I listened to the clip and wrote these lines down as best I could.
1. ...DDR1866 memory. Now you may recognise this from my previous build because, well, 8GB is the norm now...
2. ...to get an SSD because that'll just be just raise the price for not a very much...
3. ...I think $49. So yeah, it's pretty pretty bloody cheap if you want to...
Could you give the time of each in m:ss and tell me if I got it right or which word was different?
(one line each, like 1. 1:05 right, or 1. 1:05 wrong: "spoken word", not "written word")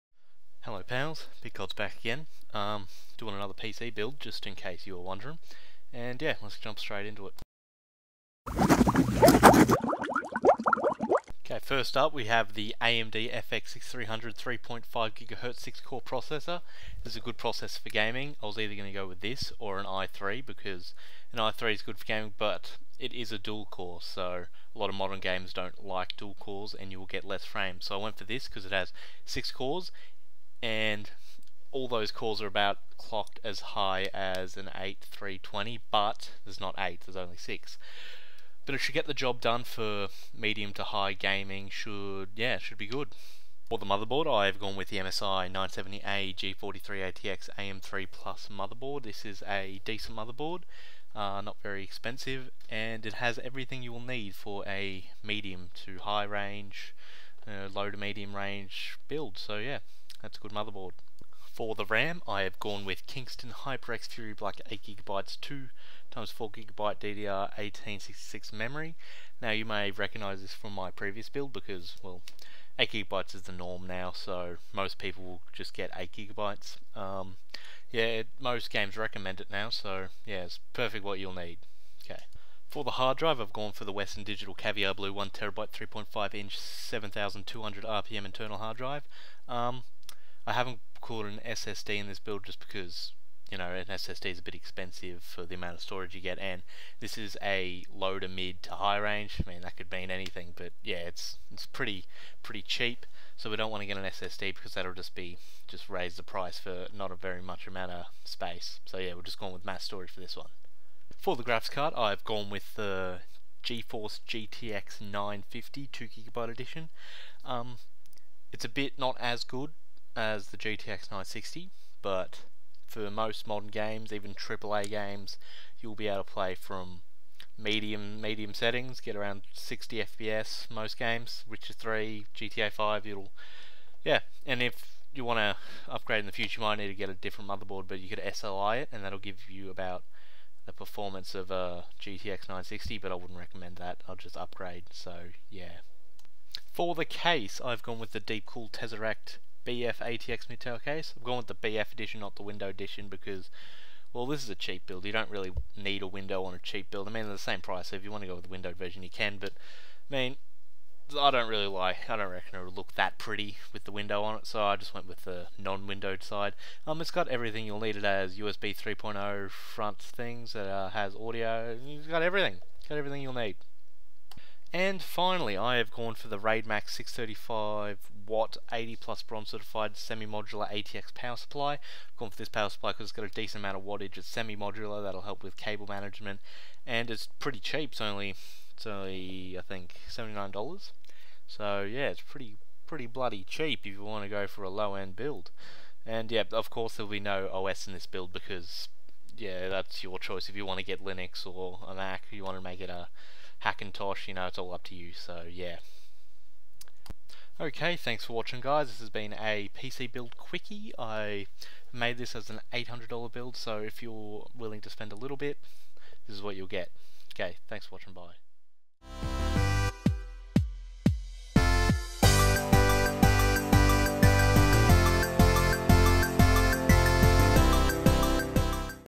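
1. 1:06 right
2. 1:43 right
3. 3:09 wrong: "79", not "49".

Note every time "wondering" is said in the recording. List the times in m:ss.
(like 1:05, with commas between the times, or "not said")
0:05.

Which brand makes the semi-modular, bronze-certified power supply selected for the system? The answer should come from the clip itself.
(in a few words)
Raidmax.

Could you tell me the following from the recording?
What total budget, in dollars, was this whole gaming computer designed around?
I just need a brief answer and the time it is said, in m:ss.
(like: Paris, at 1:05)
$800, at 3:32.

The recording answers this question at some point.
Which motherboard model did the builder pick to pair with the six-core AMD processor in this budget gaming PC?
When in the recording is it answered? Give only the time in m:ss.
0:44.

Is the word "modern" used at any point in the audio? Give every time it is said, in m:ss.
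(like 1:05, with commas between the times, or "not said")
0:24, 2:03.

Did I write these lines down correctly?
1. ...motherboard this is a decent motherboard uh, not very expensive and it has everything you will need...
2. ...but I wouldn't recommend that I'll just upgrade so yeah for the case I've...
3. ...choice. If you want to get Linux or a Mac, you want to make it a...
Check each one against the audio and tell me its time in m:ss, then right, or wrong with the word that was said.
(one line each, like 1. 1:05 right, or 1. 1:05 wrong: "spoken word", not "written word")
1. 0:48 right
2. 2:22 right
3. 3:20 right.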